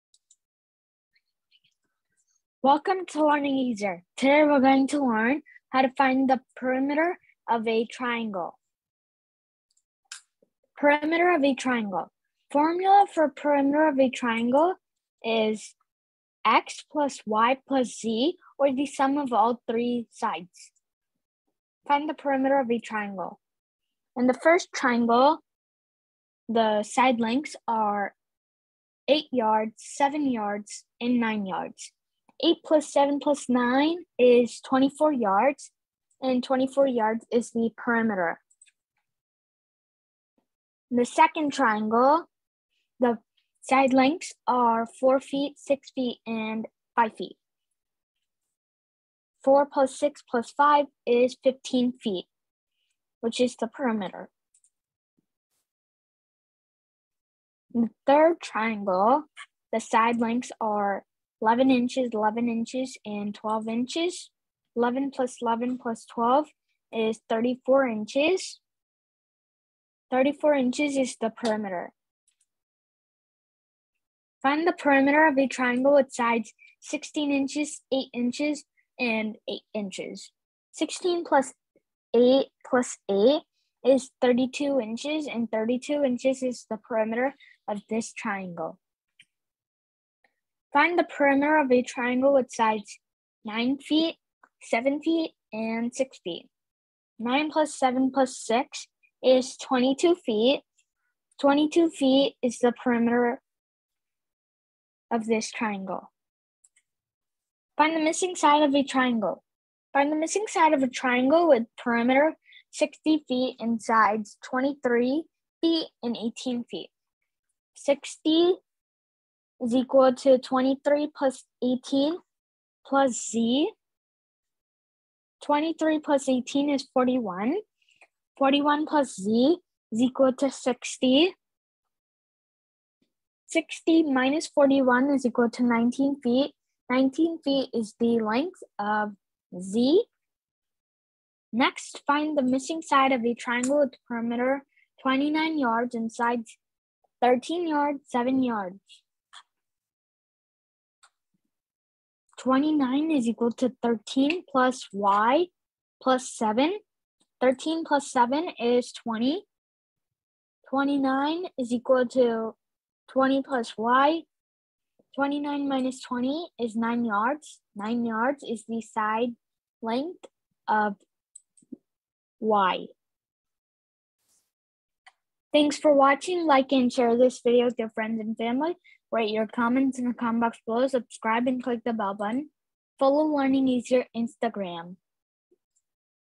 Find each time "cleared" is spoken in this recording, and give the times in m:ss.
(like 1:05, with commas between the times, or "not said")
not said.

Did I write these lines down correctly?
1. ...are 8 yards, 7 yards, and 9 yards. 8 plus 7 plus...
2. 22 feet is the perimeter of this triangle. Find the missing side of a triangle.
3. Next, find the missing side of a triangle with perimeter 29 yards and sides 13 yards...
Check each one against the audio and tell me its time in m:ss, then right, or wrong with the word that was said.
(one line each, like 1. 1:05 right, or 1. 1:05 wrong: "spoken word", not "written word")
1. 0:27 right
2. 1:41 right
3. 2:21 right.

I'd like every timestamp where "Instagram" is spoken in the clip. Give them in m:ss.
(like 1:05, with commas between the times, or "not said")
3:04.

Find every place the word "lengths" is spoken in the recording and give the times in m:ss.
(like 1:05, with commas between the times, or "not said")
0:27, 0:43, 1:00, 2:18, 2:49.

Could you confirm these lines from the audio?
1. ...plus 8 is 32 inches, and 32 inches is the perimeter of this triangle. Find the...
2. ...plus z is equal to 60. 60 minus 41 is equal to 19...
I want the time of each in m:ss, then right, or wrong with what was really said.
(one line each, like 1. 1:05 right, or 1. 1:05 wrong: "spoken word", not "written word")
1. 1:22 right
2. 2:08 right.